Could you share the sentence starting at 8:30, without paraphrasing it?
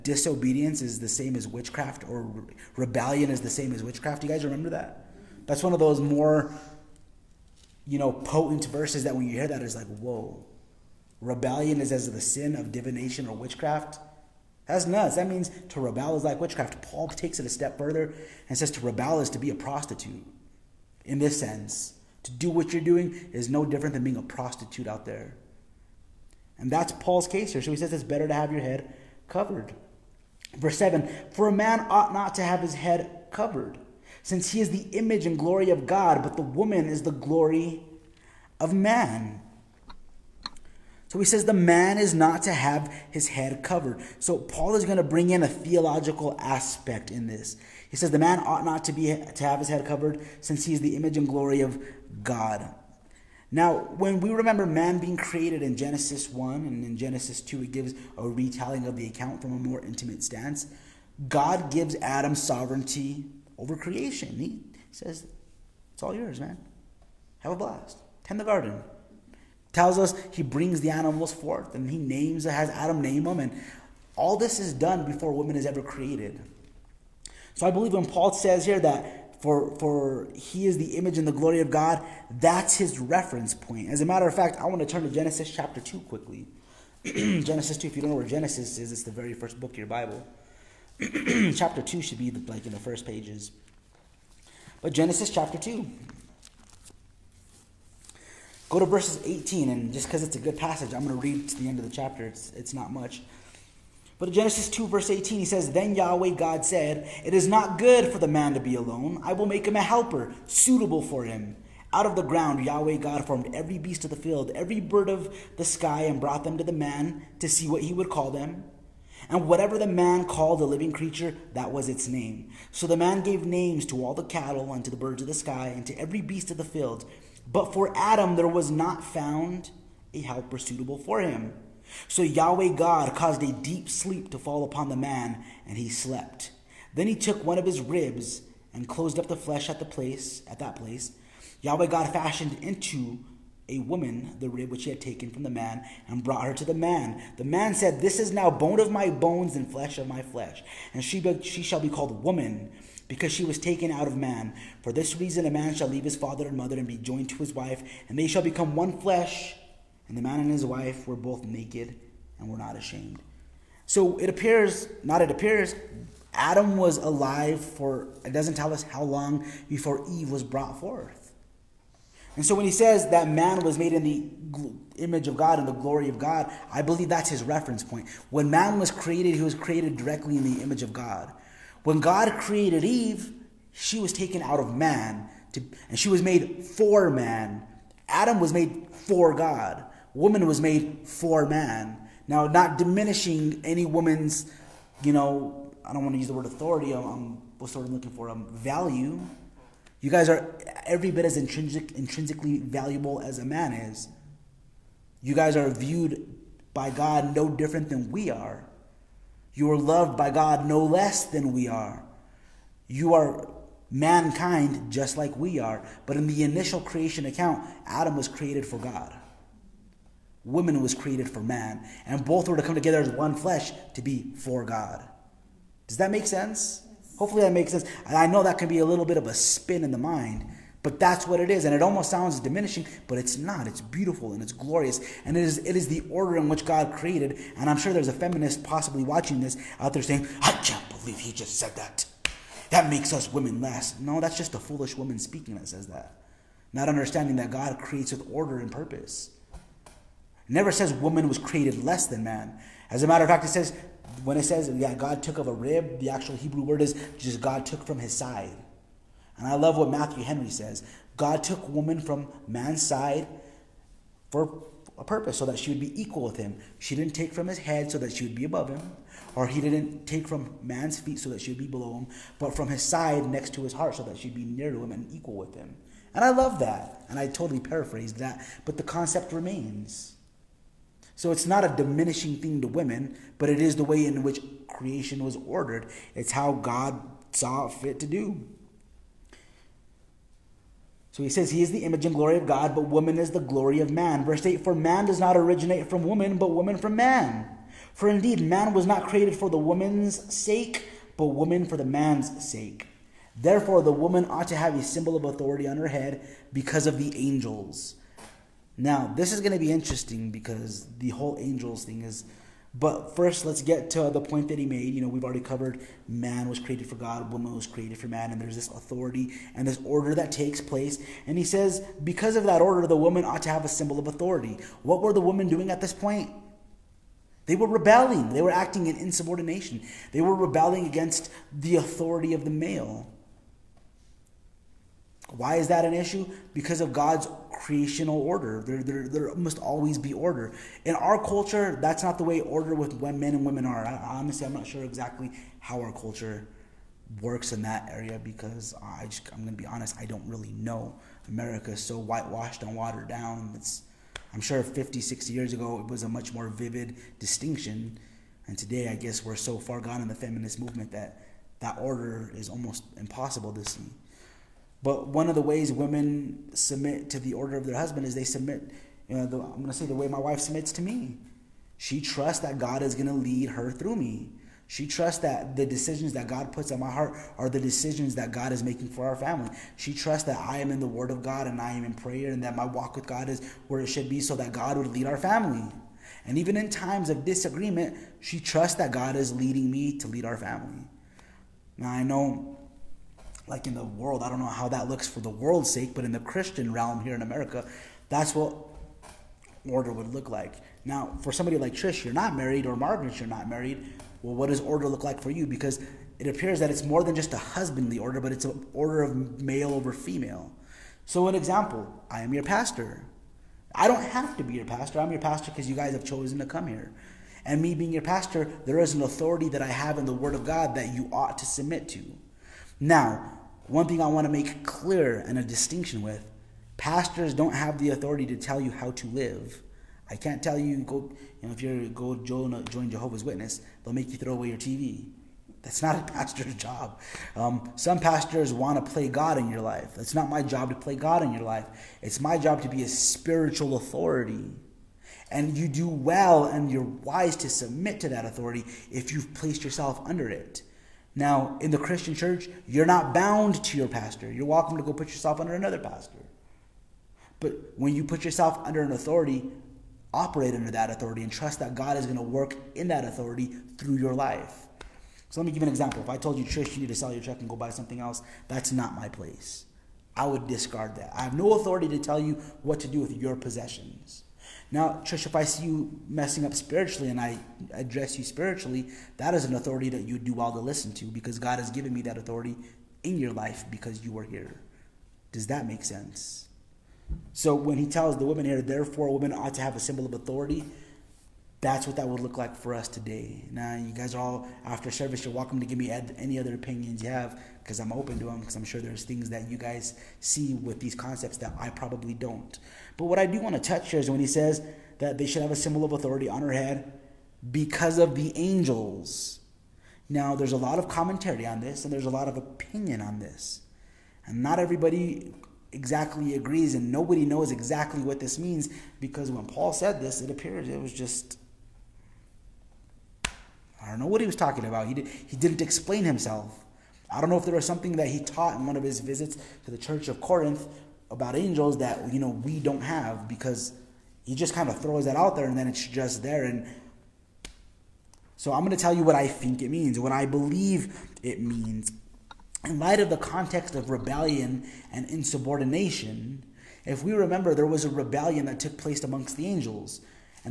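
Now, there's a lot of commentary on this, and there's a lot of opinion on this.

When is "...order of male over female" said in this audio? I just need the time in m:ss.
6:48.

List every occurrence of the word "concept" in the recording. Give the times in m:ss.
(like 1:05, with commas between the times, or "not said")
4:38, 8:20.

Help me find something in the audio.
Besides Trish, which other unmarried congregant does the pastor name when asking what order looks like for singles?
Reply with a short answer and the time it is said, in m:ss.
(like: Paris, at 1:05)
Margaret, at 6:42.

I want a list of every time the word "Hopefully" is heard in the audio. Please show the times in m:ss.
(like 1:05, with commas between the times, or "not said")
3:47.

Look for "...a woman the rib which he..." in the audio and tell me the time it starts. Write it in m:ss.
2:23.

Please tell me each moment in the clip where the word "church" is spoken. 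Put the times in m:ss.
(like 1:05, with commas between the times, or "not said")
7:32, 8:49.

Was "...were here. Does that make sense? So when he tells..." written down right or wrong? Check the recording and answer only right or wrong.
right.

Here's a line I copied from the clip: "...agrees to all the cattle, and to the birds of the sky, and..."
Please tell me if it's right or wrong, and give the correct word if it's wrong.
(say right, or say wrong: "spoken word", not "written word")
wrong: "names", not "agrees".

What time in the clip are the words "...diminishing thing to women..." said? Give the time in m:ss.
4:41.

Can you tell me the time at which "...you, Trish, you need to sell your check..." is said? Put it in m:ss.
7:46.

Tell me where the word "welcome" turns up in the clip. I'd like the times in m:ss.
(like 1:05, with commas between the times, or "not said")
7:34, 8:15.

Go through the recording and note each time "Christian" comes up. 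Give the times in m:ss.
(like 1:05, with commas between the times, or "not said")
6:36, 7:31.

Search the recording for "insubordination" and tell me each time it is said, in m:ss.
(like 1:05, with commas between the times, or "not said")
5:28, 9:05.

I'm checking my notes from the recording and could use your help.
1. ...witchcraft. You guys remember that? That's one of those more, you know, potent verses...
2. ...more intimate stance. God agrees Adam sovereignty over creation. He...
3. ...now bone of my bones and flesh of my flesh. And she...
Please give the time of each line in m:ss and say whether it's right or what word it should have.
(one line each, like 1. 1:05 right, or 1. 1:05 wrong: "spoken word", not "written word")
1. 0:03 right
2. 0:59 wrong: "gives", not "agrees"
3. 2:28 right.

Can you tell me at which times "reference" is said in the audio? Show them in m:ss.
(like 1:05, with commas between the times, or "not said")
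1:22, 2:57.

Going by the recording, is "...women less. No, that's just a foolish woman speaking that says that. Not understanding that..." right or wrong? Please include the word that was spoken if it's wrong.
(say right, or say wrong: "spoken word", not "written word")
right.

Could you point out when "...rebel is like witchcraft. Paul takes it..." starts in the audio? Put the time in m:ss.
0:15.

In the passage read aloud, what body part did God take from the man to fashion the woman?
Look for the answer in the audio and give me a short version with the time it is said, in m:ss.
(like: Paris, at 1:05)
one of his ribs, at 2:17.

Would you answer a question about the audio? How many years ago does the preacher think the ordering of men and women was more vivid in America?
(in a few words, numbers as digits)
50, 60 years.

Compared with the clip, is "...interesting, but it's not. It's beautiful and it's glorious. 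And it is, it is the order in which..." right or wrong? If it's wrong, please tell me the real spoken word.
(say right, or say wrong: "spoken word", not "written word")
wrong: "diminishing", not "interesting".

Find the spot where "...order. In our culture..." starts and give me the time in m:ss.
5:40.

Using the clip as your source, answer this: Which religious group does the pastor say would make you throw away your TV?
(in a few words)
Jehovah's Witness.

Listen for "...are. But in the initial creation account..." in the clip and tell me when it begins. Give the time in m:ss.
3:35.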